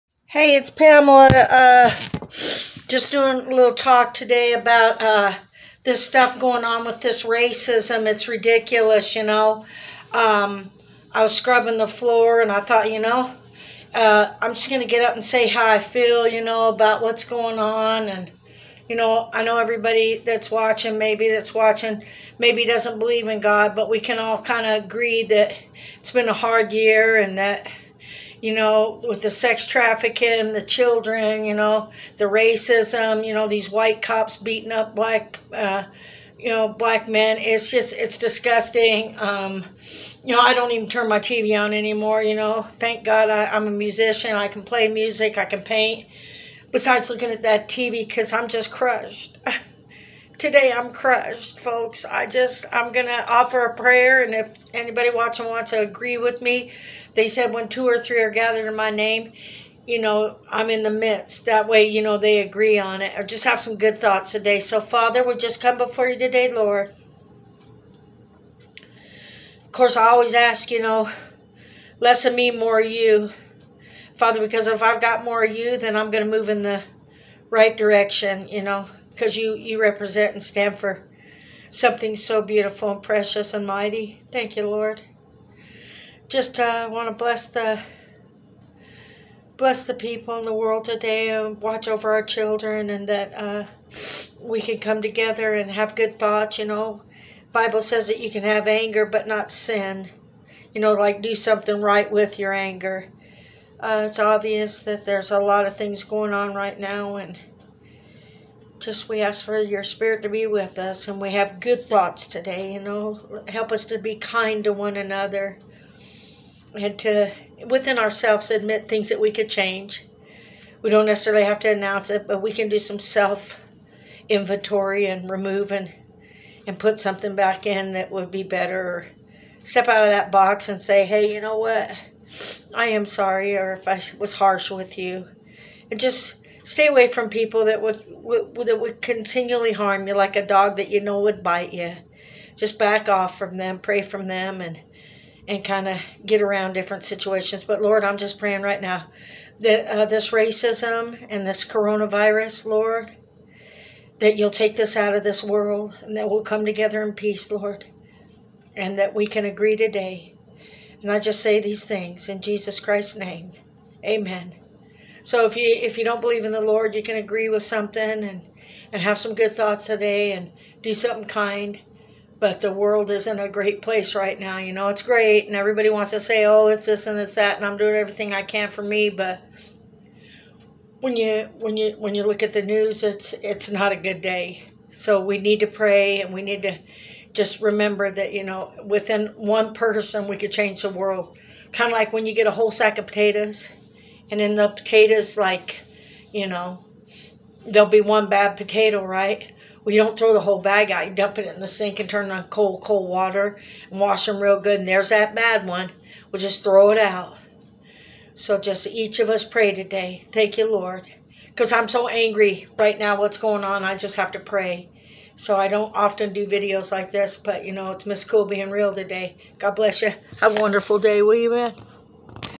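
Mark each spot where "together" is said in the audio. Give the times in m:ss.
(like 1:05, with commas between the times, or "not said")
1:35, 2:36.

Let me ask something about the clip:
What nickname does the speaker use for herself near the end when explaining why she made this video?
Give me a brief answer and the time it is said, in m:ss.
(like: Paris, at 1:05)
Miss Cool, at 3:38.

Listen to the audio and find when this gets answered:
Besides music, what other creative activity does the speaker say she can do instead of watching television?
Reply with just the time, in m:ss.
0:45.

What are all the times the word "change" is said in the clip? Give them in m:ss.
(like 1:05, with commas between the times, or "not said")
1:59, 3:10.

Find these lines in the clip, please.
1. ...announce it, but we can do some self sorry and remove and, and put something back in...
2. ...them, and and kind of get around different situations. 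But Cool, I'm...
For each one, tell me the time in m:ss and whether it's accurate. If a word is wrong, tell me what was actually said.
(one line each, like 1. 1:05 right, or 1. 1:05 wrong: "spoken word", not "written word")
1. 2:01 wrong: "inventory", not "sorry"
2. 2:24 wrong: "Lord", not "Cool".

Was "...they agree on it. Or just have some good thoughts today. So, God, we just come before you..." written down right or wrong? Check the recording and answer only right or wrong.
wrong.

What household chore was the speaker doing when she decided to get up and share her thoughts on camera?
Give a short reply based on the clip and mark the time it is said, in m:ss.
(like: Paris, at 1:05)
Scrubbing the floor, at 0:11.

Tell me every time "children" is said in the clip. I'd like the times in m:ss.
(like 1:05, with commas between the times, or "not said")
0:30, 1:32.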